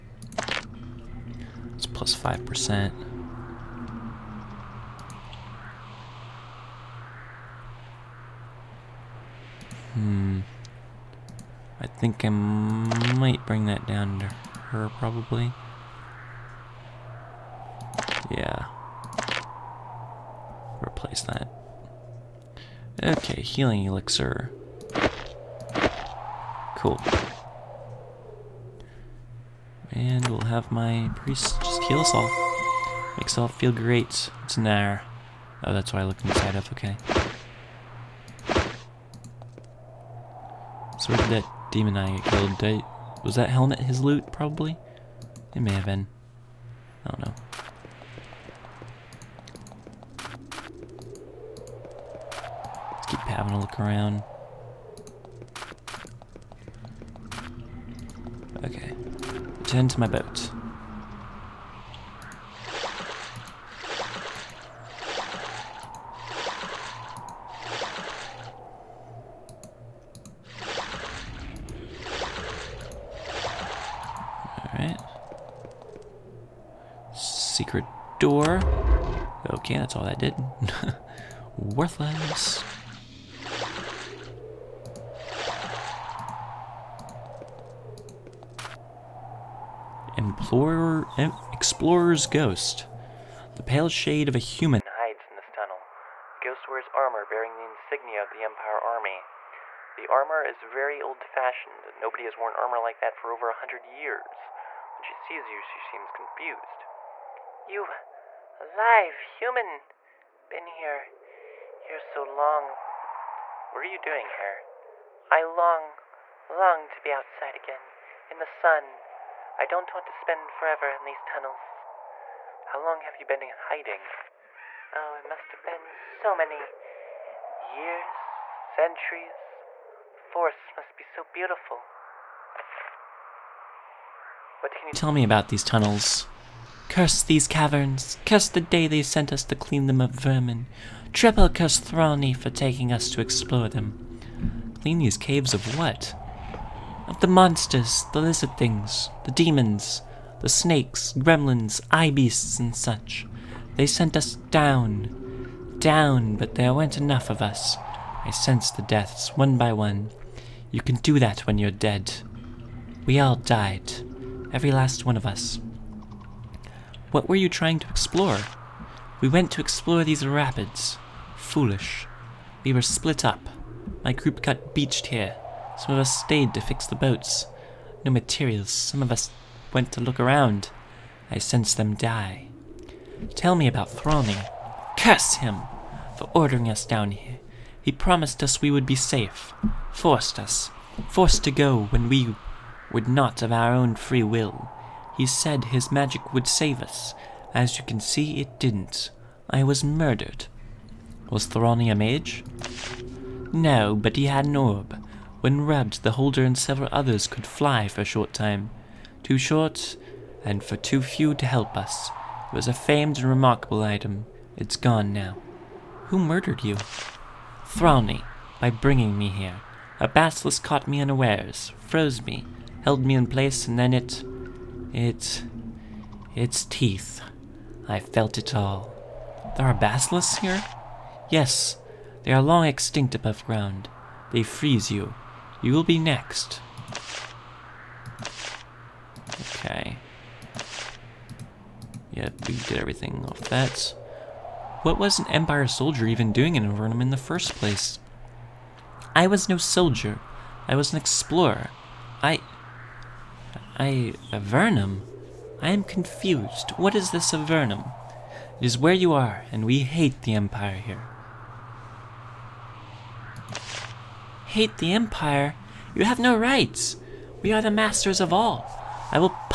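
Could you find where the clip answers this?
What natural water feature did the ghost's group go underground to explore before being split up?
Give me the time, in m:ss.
2:50.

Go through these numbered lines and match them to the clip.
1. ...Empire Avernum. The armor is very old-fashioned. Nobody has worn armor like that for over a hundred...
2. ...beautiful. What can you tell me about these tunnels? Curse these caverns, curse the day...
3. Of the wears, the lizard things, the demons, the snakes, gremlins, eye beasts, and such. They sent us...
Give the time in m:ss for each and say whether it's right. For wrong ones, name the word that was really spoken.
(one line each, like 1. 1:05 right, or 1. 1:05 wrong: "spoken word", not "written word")
1. 1:38 wrong: "Army", not "Avernum"
2. 2:11 right
3. 2:27 wrong: "monsters", not "wears".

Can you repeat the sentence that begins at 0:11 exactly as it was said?
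I think I might bring that down to her, probably.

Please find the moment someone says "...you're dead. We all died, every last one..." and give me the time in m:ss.
2:41.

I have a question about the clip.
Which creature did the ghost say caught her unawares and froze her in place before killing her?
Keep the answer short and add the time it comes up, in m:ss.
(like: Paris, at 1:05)
A basilisk, at 3:39.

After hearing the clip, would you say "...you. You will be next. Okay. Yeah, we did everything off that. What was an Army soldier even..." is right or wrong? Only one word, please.
wrong.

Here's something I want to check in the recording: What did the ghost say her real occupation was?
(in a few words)
An explorer.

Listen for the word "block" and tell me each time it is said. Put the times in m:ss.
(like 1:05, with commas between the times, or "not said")
not said.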